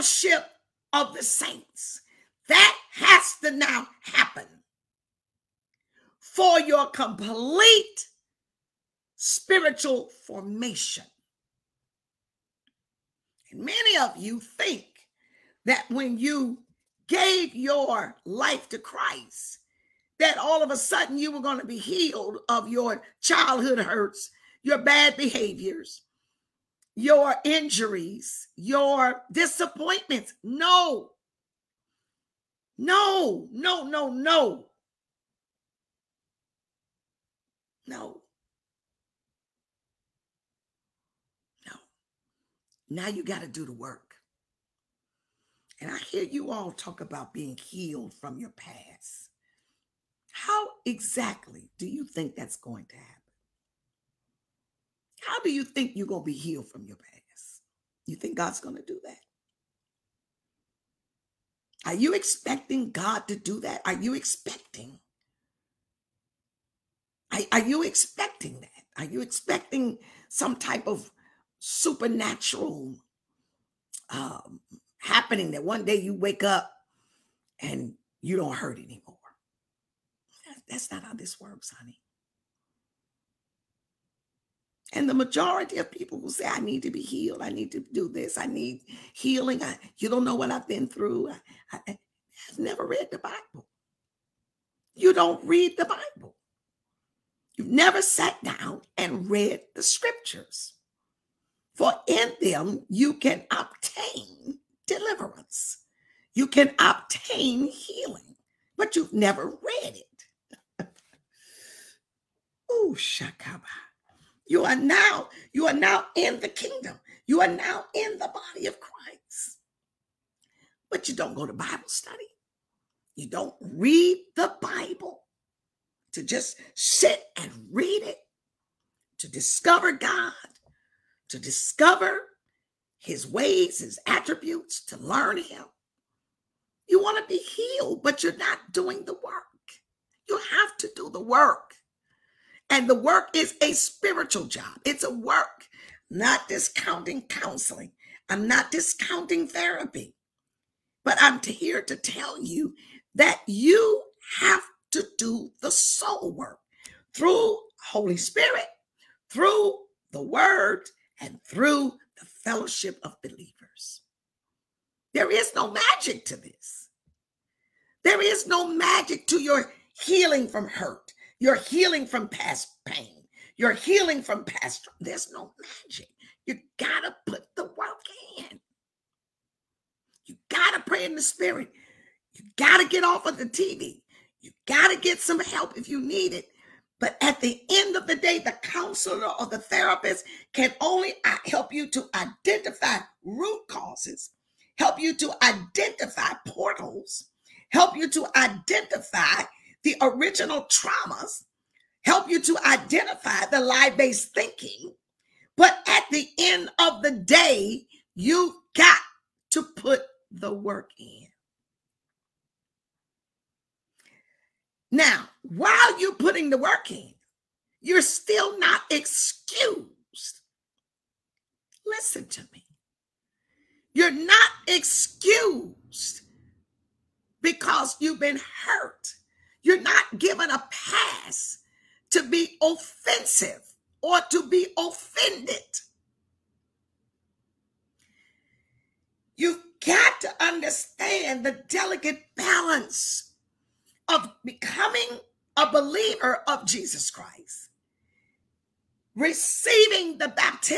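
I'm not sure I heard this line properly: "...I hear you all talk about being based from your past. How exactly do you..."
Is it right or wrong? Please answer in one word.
wrong.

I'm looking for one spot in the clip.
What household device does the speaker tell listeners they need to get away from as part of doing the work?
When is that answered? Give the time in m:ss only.
3:03.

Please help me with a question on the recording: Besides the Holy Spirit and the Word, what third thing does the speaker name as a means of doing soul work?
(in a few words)
Fellowship of believers.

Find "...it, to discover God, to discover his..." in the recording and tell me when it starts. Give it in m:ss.
2:08.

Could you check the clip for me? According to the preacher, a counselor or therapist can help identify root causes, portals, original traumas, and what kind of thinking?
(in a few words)
Lie based thinking.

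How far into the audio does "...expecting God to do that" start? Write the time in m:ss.
1:02.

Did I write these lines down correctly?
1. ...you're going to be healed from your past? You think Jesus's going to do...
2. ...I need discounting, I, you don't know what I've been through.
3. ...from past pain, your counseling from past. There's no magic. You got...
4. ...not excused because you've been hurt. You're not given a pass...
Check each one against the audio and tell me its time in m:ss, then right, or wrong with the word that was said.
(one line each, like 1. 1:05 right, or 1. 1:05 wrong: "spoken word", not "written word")
1. 0:55 wrong: "God", not "Jesus"
2. 1:28 wrong: "healing", not "discounting"
3. 2:52 wrong: "healing", not "counseling"
4. 3:44 right.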